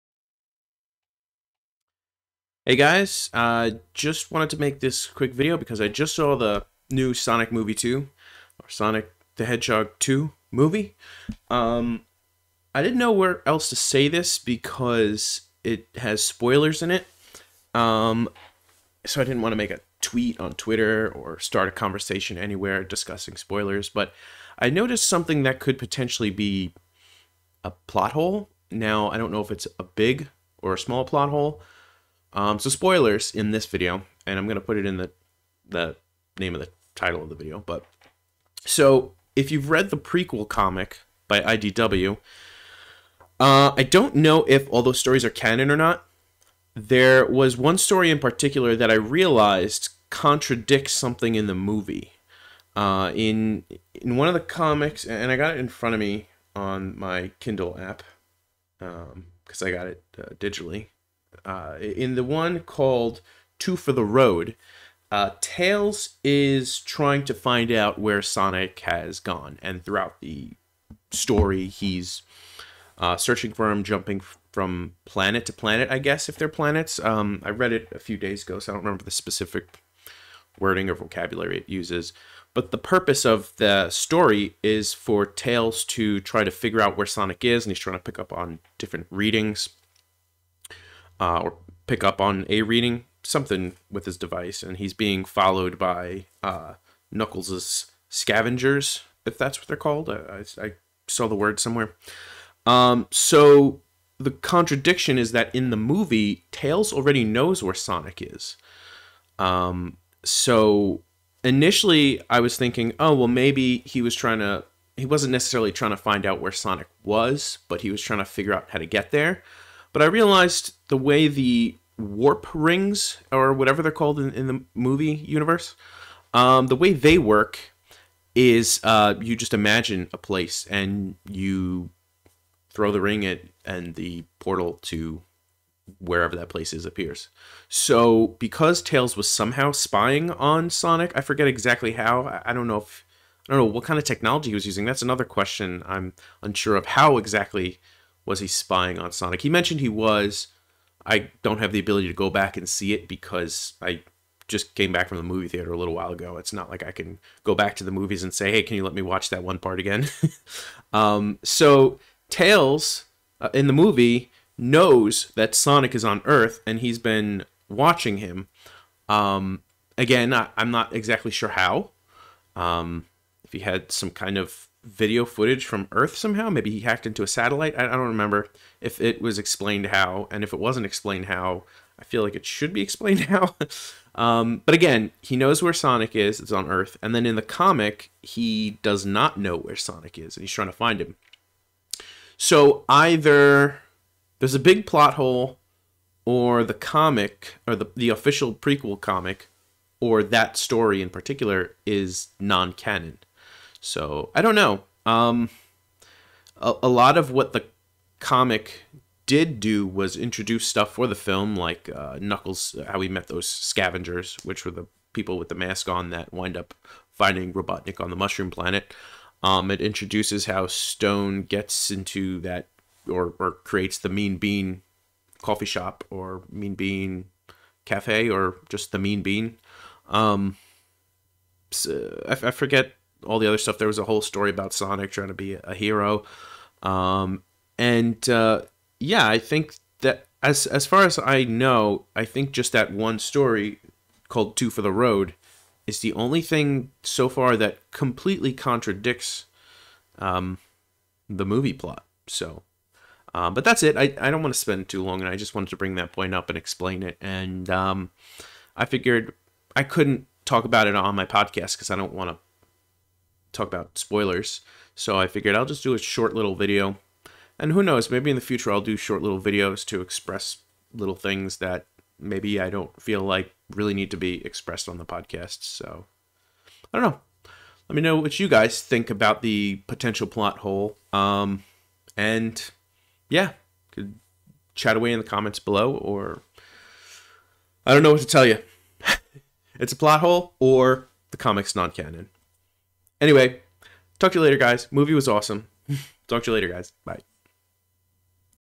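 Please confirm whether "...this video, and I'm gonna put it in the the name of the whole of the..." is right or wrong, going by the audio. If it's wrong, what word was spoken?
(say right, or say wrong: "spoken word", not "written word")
wrong: "title", not "whole".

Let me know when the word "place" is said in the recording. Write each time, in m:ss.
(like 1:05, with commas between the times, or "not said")
2:10, 2:16.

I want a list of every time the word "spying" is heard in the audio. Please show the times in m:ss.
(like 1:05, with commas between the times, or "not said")
2:19, 2:28.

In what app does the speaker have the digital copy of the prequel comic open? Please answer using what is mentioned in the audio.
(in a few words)
Kindle app.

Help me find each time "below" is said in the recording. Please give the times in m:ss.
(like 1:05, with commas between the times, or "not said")
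4:45.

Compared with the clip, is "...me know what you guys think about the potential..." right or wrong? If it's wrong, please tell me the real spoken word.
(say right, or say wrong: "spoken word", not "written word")
right.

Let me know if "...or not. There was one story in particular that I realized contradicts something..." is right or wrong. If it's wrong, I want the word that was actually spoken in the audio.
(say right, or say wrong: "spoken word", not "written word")
right.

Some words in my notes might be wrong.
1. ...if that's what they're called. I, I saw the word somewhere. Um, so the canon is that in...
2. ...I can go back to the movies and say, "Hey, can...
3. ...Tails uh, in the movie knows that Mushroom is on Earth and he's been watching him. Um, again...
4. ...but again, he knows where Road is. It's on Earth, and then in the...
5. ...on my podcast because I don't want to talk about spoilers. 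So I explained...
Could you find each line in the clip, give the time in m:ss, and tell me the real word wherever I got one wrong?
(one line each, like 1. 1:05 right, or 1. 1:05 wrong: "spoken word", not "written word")
1. 1:39 wrong: "contradiction", not "canon"
2. 2:36 right
3. 2:42 wrong: "Sonic", not "Mushroom"
4. 3:04 wrong: "Sonic", not "Road"
5. 4:20 wrong: "figured", not "explained".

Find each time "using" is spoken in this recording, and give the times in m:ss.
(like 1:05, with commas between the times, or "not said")
2:24.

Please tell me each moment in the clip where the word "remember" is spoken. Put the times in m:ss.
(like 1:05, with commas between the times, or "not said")
1:18, 2:57.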